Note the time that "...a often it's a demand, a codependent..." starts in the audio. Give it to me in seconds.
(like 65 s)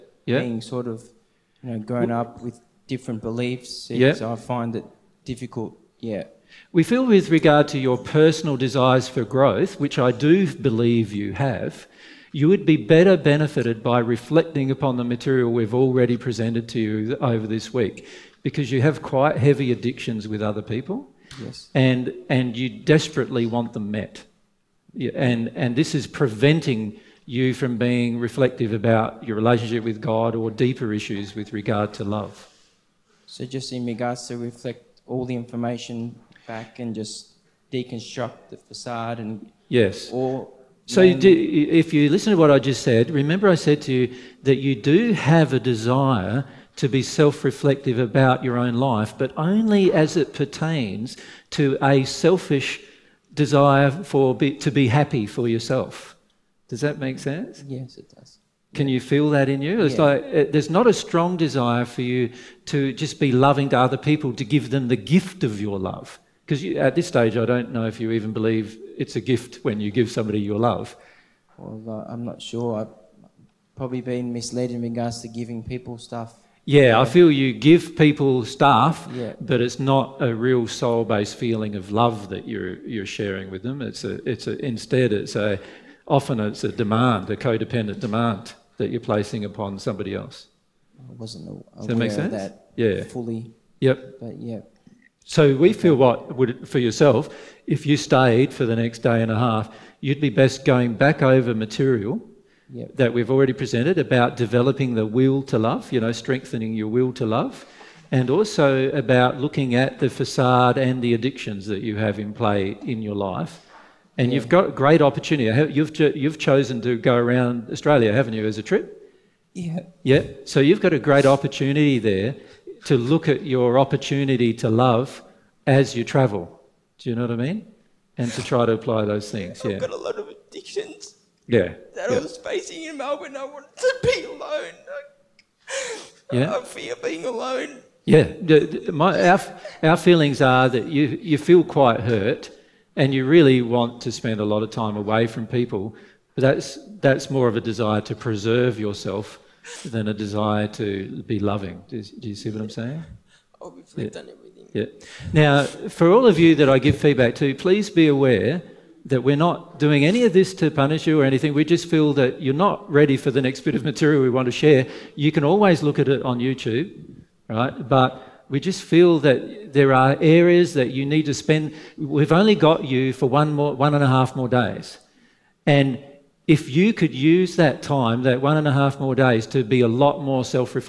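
85 s.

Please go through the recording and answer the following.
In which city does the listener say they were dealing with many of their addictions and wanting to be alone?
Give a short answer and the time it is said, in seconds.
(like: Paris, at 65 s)
Melbourne, at 132 s.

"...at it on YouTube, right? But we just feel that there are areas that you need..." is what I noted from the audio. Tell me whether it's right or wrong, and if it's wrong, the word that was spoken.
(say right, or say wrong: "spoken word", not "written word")
right.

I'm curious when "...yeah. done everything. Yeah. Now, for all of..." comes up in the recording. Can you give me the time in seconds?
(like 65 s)
153 s.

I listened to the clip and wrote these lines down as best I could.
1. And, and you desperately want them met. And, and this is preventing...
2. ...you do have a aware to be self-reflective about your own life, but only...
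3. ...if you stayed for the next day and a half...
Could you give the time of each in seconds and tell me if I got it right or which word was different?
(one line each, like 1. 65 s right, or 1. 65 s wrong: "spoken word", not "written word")
1. 21 s right
2. 44 s wrong: "desire", not "aware"
3. 97 s right.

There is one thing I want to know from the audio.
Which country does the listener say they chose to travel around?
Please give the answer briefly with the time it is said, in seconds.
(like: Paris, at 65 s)
Australia, at 117 s.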